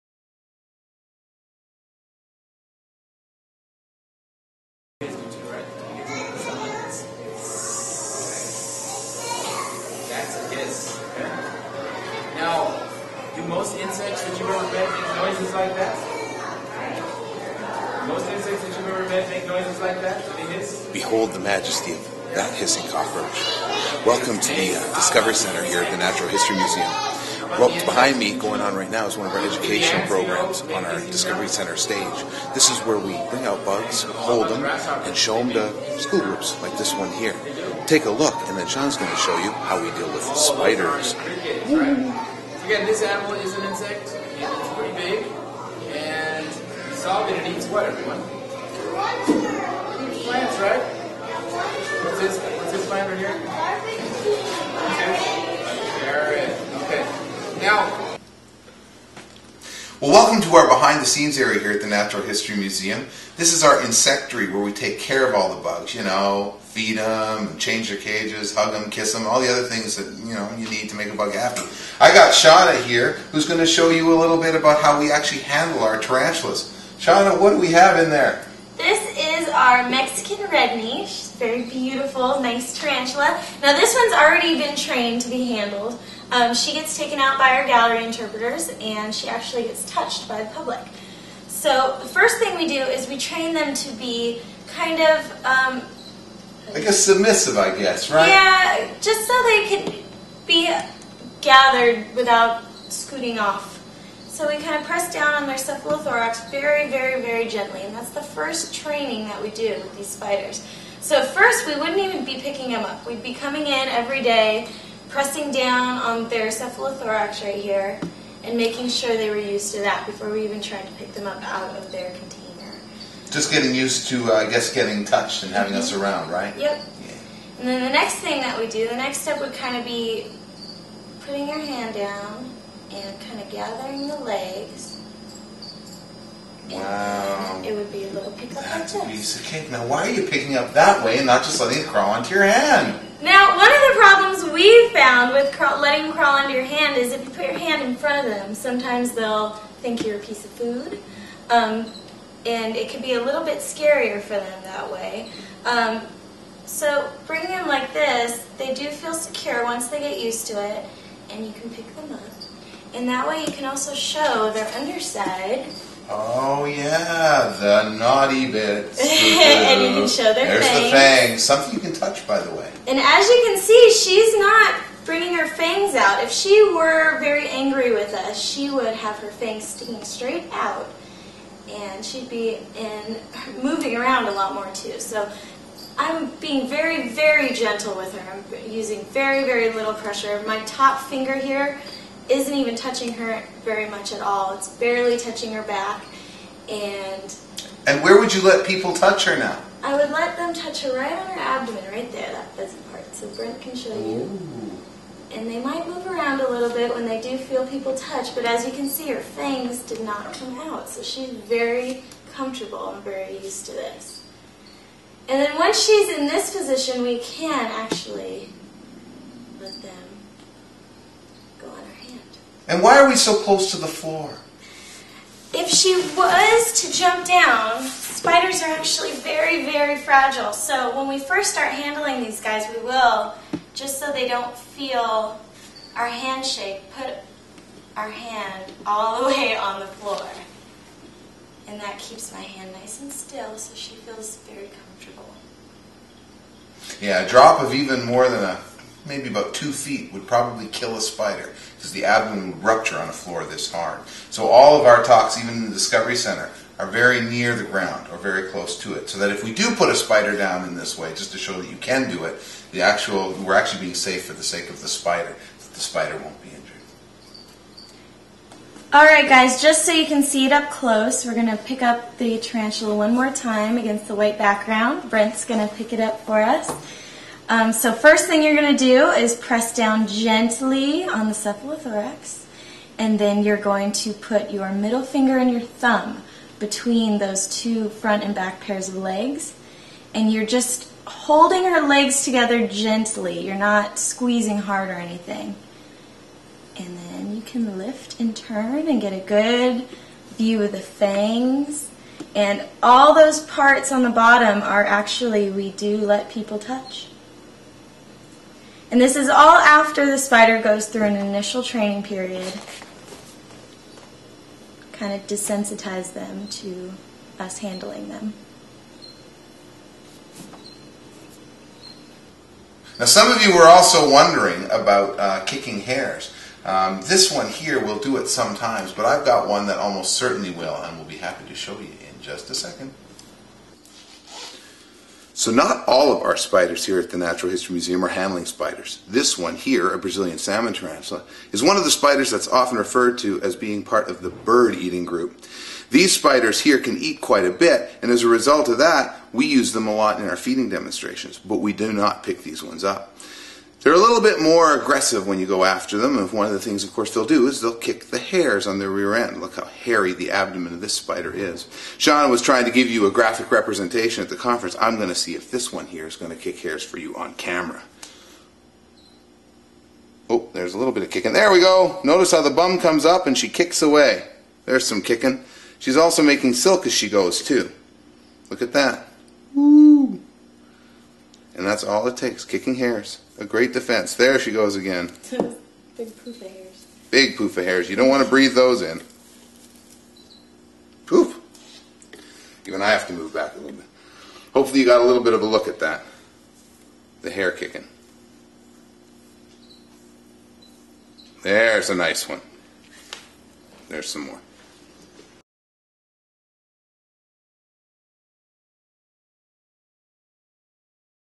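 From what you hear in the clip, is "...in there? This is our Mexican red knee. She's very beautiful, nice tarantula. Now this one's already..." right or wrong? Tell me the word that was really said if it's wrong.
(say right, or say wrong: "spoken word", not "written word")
right.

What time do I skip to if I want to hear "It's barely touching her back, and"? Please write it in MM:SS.
03:14.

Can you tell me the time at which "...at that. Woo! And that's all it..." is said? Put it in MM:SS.
06:18.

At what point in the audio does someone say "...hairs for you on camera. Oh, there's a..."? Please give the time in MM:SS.
06:06.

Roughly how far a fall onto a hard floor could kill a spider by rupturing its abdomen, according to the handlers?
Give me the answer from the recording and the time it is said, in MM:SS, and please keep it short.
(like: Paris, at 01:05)
2 feet, at 04:09.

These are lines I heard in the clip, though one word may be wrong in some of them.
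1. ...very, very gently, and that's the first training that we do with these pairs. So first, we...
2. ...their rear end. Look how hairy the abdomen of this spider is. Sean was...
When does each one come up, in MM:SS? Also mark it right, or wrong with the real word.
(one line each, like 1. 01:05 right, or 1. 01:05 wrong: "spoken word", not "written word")
1. 01:46 wrong: "spiders", not "pairs"
2. 05:58 right.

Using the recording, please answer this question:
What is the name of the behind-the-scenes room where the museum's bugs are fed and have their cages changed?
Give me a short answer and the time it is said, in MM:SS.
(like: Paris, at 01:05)
Insectary, at 01:03.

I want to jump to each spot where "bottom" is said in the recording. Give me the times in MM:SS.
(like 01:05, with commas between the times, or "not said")
05:04.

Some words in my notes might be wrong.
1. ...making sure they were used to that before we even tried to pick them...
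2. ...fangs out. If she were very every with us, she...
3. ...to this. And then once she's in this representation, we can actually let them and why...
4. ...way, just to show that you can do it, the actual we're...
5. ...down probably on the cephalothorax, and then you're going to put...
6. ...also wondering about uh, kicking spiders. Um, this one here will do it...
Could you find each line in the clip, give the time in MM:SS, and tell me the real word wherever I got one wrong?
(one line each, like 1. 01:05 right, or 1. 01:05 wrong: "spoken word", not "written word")
1. 01:58 right
2. 02:55 wrong: "angry", not "every"
3. 03:33 wrong: "position", not "representation"
4. 04:20 right
5. 04:39 wrong: "gently", not "probably"
6. 05:23 wrong: "hairs", not "spiders".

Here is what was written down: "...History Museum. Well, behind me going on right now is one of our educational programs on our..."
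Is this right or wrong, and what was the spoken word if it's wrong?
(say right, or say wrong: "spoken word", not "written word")
right.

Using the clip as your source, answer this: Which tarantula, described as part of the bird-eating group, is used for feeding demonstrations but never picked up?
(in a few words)
Brazilian salmon tarantula.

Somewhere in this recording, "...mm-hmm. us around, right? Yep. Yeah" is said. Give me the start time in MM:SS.
02:05.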